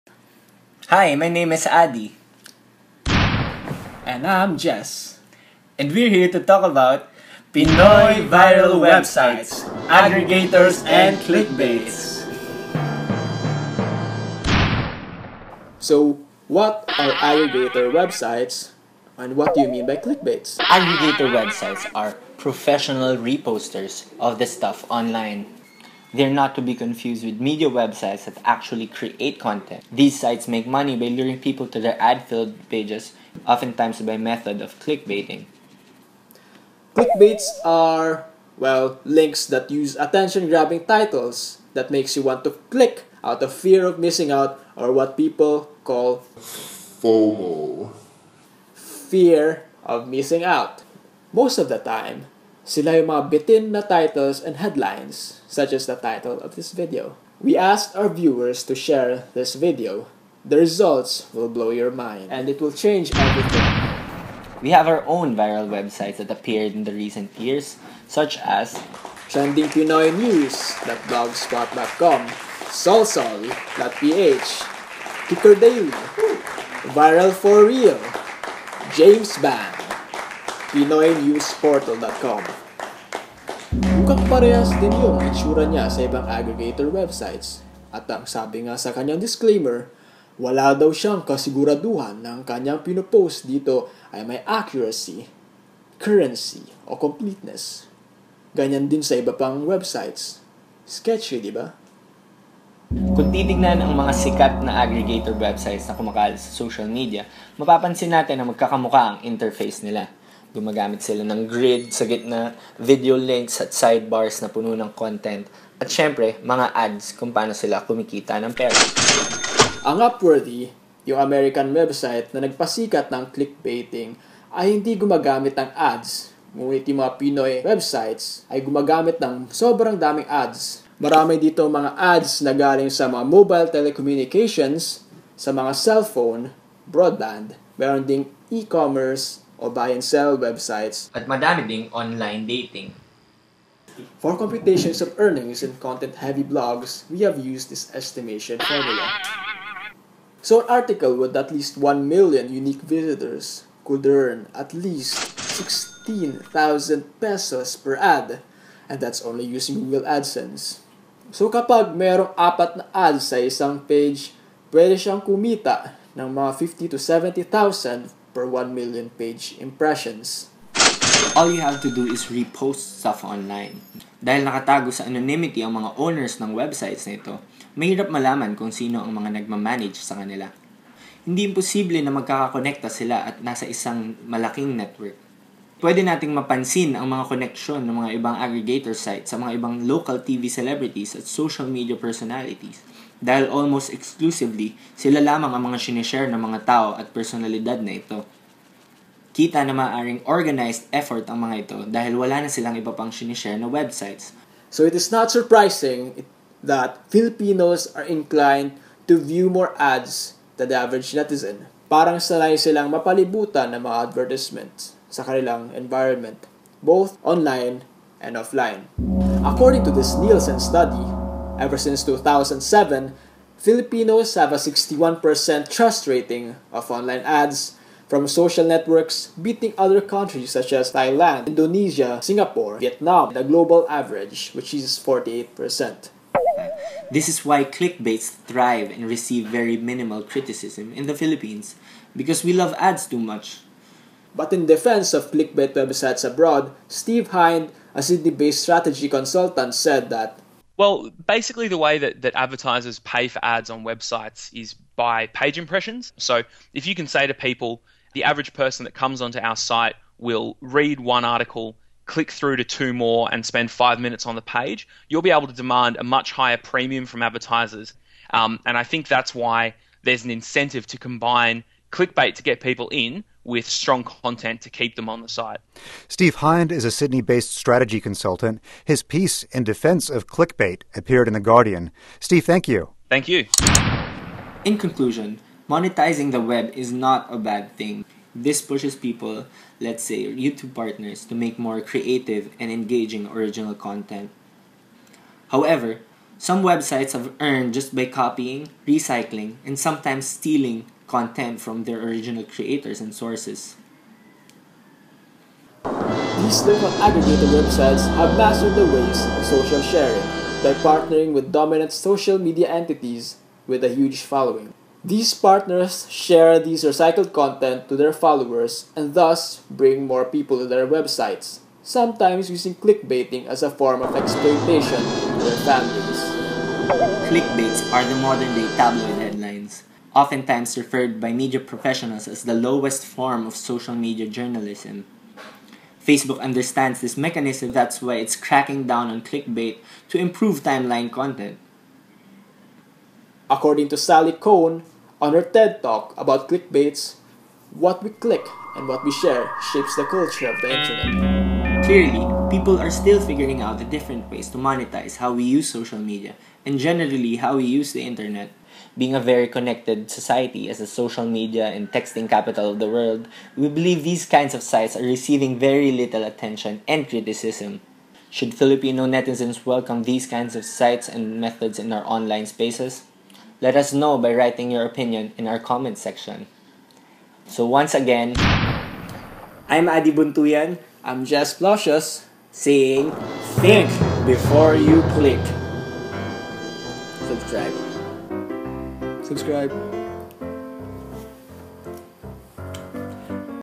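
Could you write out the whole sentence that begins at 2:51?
All you have to do is repost stuff online.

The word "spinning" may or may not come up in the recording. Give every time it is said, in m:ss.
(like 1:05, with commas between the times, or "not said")
not said.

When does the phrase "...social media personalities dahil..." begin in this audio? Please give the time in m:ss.
3:11.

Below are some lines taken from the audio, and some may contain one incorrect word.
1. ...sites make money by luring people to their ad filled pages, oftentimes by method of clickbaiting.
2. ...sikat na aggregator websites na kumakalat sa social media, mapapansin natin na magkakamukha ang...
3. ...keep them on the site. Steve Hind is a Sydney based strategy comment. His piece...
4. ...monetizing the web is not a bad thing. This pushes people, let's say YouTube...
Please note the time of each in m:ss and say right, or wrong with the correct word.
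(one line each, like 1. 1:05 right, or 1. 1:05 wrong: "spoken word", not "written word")
1. 0:30 right
2. 1:44 right
3. 4:34 wrong: "consultant", not "comment"
4. 4:45 right.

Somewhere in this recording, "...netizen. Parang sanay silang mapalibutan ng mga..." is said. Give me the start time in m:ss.
3:31.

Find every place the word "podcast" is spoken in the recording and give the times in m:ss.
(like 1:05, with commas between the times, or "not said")
not said.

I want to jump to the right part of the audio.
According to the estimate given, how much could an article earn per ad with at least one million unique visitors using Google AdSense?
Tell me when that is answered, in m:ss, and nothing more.
2:35.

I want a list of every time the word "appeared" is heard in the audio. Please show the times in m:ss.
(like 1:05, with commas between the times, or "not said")
1:06, 4:40.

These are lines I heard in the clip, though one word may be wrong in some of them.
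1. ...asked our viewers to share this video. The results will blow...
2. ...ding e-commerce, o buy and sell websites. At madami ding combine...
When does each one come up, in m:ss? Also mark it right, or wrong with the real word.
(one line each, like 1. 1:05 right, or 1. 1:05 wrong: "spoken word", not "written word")
1. 0:57 right
2. 2:18 wrong: "online", not "combine".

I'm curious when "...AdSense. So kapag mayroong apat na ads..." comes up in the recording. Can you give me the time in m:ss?
2:40.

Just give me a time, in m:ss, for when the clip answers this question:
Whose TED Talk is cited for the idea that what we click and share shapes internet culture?
5:43.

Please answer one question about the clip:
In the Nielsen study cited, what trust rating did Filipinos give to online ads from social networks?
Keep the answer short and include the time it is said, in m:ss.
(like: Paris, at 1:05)
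61%, at 3:44.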